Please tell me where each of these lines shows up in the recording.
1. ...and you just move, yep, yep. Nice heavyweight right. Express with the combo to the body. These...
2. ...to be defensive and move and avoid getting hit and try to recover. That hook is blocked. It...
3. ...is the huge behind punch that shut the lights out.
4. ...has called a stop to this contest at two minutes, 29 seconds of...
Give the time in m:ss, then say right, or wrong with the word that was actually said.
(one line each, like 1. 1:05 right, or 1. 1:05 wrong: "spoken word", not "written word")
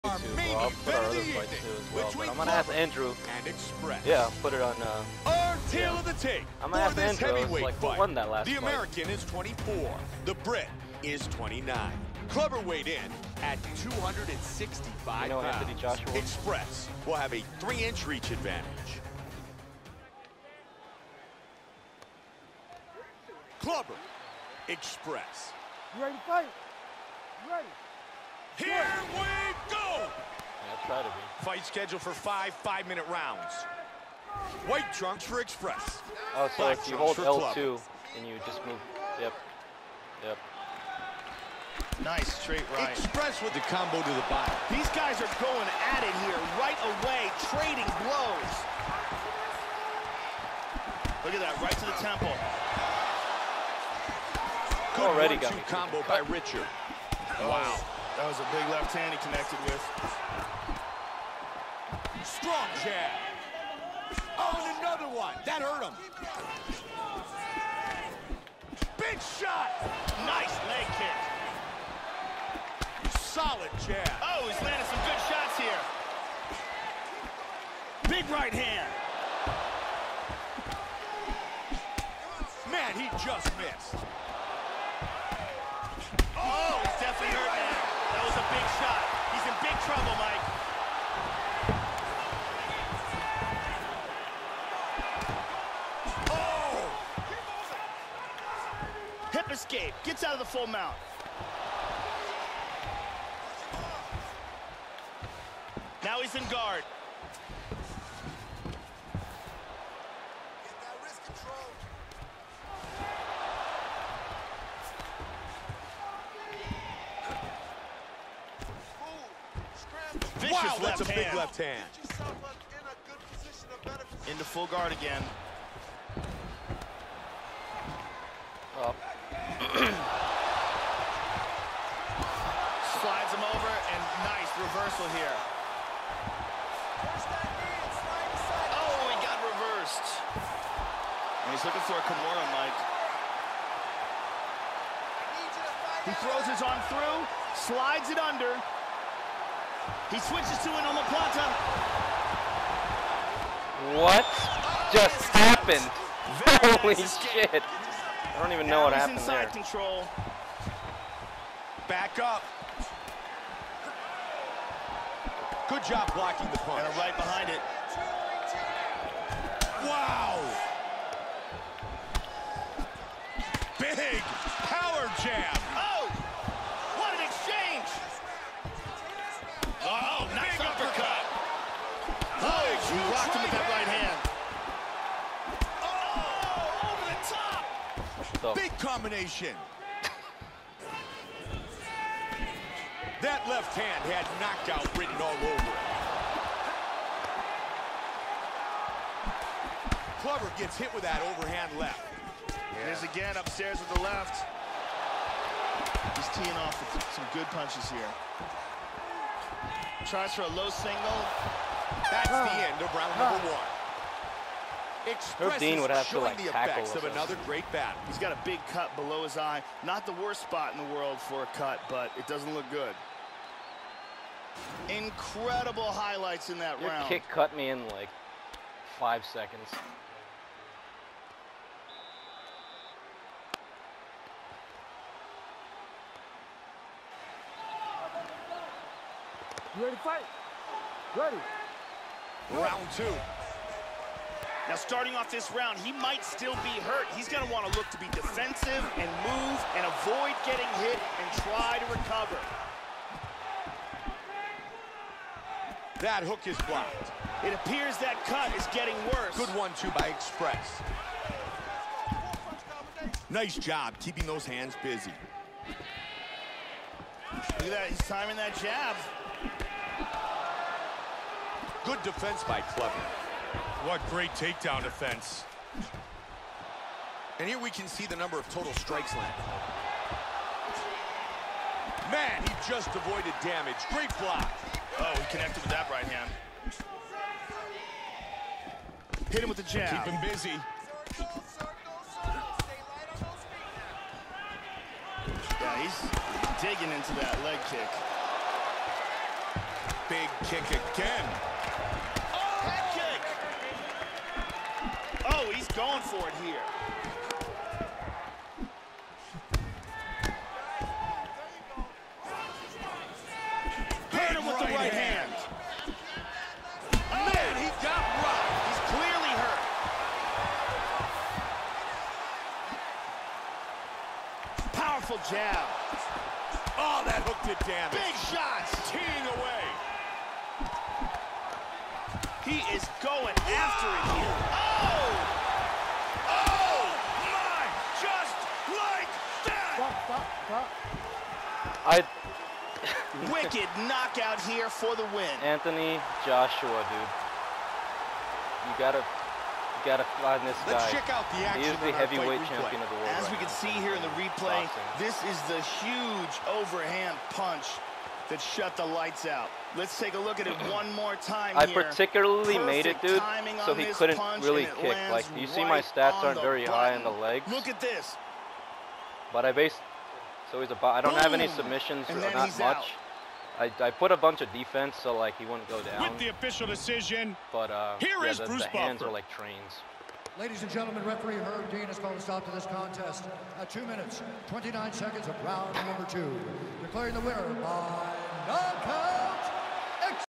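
1. 0:38 wrong: "straight", not "heavyweight"
2. 4:07 right
3. 5:55 wrong: "overhand", not "behind"
4. 6:21 right.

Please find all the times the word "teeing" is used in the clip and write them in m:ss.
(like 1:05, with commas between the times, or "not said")
3:26, 5:28.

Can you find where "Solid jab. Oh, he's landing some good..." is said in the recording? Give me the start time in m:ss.
1:13.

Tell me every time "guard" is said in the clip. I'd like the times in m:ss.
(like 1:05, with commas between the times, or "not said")
1:46, 2:04.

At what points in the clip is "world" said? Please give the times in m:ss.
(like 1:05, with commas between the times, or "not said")
3:40, 5:52.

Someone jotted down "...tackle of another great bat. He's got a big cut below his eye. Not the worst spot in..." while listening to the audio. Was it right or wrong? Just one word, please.
right.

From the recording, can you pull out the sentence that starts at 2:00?
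Vicious wow, that's left a big left hand.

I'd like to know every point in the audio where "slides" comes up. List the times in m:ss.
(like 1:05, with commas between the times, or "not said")
2:09, 2:27.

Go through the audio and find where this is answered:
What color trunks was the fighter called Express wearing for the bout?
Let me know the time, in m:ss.
0:34.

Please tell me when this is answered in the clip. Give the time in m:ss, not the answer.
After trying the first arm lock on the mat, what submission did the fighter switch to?
2:30.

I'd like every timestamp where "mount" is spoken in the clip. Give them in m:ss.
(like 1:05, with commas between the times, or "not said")
1:40.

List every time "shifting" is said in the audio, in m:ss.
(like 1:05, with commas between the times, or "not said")
not said.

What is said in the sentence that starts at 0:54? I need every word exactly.
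Good Already got combo by Richard.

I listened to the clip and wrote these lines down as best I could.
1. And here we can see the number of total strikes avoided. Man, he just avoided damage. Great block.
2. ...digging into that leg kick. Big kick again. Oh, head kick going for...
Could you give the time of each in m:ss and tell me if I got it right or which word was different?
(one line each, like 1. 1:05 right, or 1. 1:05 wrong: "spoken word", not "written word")
1. 4:37 wrong: "landed", not "avoided"
2. 4:56 right.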